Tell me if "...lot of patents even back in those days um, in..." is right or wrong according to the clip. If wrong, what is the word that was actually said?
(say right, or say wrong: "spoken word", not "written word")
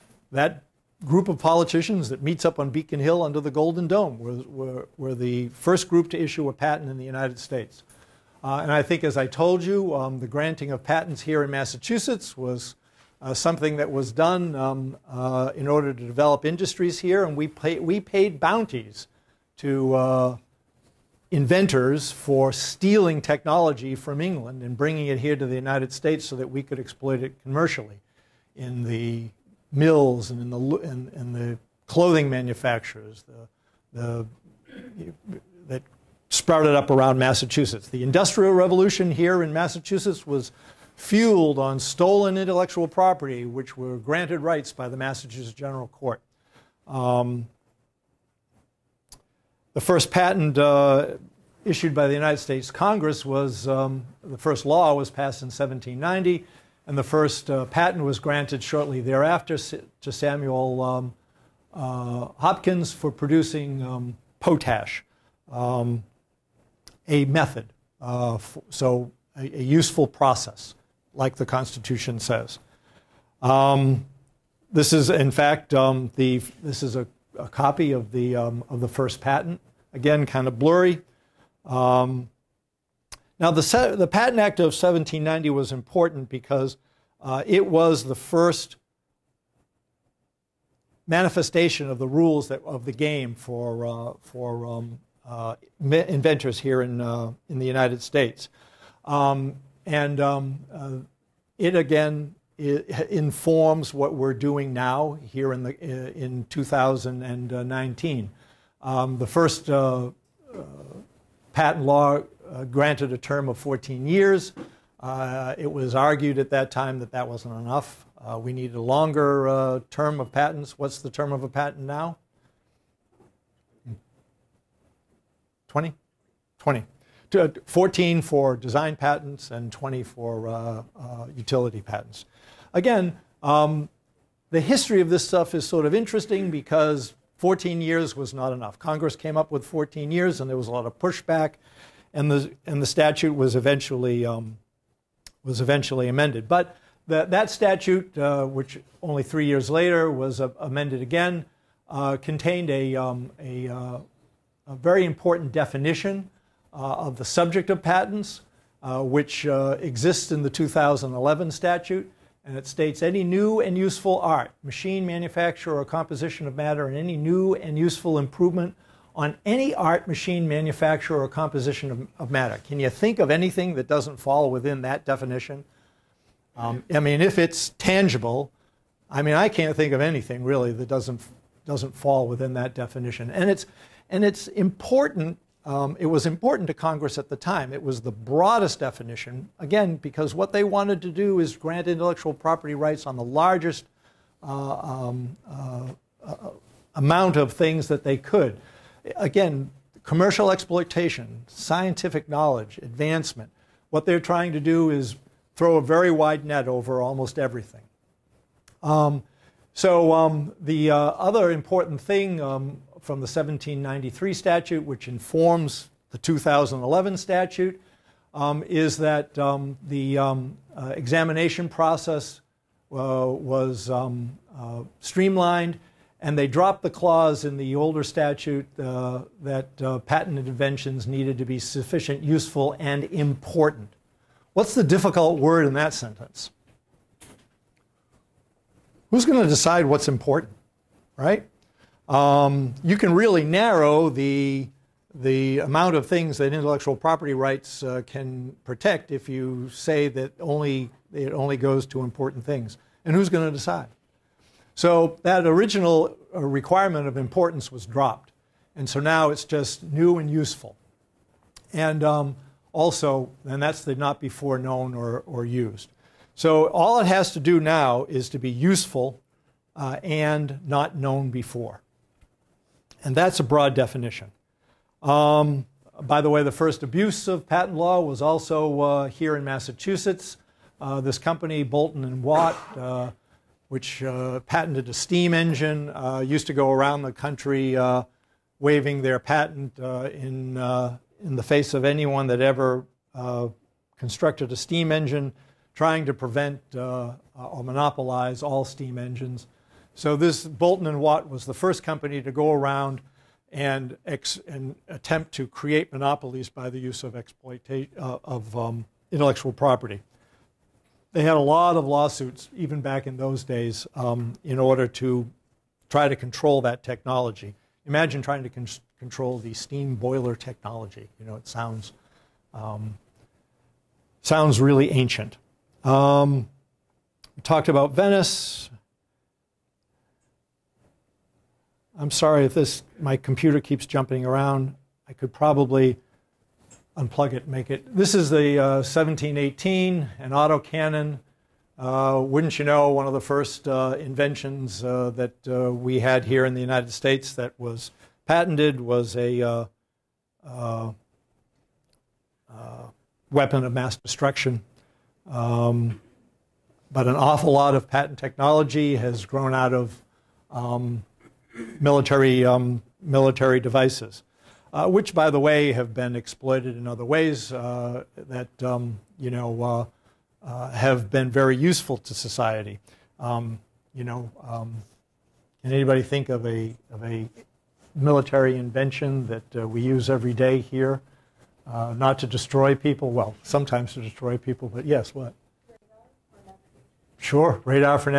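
wrong: "lawsuits", not "patents".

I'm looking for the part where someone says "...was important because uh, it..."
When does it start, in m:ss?
1:25.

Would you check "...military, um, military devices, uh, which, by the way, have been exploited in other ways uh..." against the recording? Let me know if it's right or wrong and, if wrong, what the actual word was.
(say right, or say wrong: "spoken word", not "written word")
right.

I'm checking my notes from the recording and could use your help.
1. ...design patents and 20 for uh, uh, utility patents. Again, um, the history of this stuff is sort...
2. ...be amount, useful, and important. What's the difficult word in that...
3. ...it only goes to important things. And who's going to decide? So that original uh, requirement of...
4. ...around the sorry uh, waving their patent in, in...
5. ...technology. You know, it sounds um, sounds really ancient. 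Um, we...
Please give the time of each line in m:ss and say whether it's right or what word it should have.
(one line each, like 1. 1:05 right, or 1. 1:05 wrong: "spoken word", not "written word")
1. 2:08 right
2. 3:51 wrong: "sufficient", not "amount"
3. 4:11 right
4. 4:46 wrong: "country", not "sorry"
5. 5:20 right.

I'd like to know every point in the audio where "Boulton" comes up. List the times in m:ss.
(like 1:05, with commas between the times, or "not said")
4:41, 5:00.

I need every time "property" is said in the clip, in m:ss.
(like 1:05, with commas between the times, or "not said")
0:42, 3:12, 4:06, 5:09.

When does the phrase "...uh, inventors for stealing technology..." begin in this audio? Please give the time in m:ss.
0:19.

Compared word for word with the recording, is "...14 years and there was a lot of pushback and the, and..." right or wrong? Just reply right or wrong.
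right.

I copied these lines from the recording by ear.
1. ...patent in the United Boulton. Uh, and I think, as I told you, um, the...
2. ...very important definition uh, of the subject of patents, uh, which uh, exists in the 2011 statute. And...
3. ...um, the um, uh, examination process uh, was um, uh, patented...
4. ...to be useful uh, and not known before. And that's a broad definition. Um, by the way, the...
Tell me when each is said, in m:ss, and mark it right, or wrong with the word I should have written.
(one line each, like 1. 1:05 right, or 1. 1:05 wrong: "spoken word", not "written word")
1. 0:06 wrong: "States", not "Boulton"
2. 2:34 right
3. 3:39 wrong: "streamlined", not "patented"
4. 4:28 right.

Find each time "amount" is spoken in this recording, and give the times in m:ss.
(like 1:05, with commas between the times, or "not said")
3:16, 4:05.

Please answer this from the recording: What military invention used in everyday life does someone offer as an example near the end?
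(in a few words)
Radar.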